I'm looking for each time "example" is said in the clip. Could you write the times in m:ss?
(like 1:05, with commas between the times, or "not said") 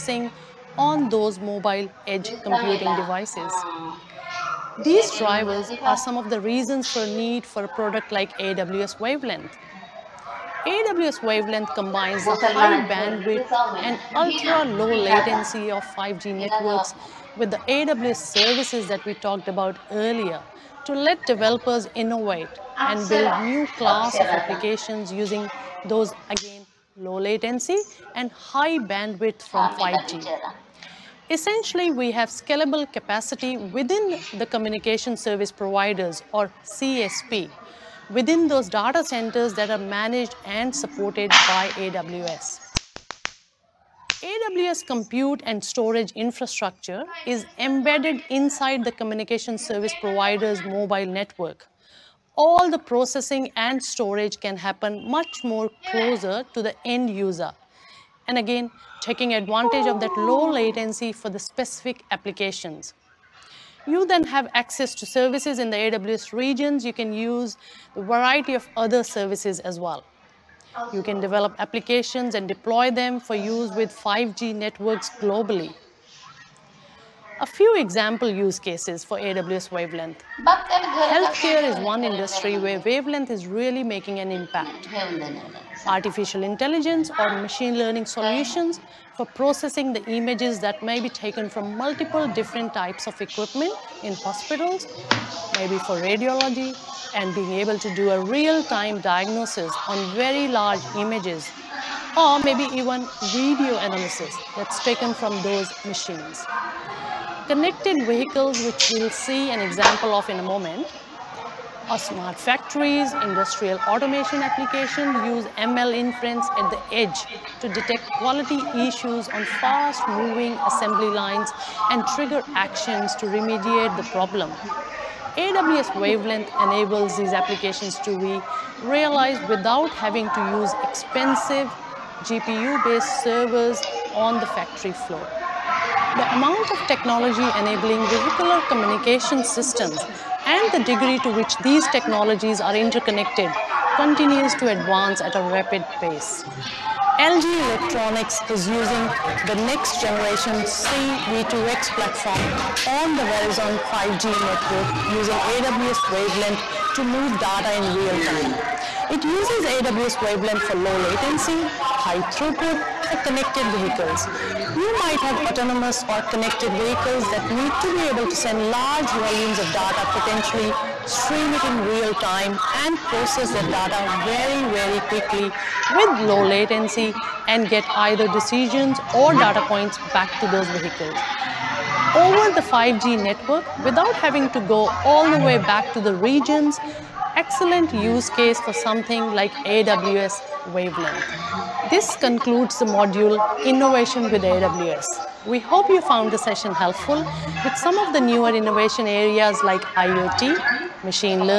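1:17, 1:49.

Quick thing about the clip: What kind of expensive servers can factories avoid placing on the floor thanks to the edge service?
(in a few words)
GPU-based servers.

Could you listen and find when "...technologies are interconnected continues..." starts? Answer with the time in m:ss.
2:21.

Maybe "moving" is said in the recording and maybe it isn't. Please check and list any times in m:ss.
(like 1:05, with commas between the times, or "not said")
1:59.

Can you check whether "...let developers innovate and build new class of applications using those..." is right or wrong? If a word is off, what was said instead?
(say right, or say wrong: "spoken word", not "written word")
right.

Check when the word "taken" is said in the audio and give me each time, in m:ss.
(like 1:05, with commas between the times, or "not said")
1:31, 1:44.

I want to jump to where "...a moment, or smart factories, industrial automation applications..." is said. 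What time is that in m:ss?
1:50.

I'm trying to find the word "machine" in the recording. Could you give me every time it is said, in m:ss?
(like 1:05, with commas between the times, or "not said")
1:27, 1:45, 3:21.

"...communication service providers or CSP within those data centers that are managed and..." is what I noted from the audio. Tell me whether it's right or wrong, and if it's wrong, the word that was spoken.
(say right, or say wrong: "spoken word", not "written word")
right.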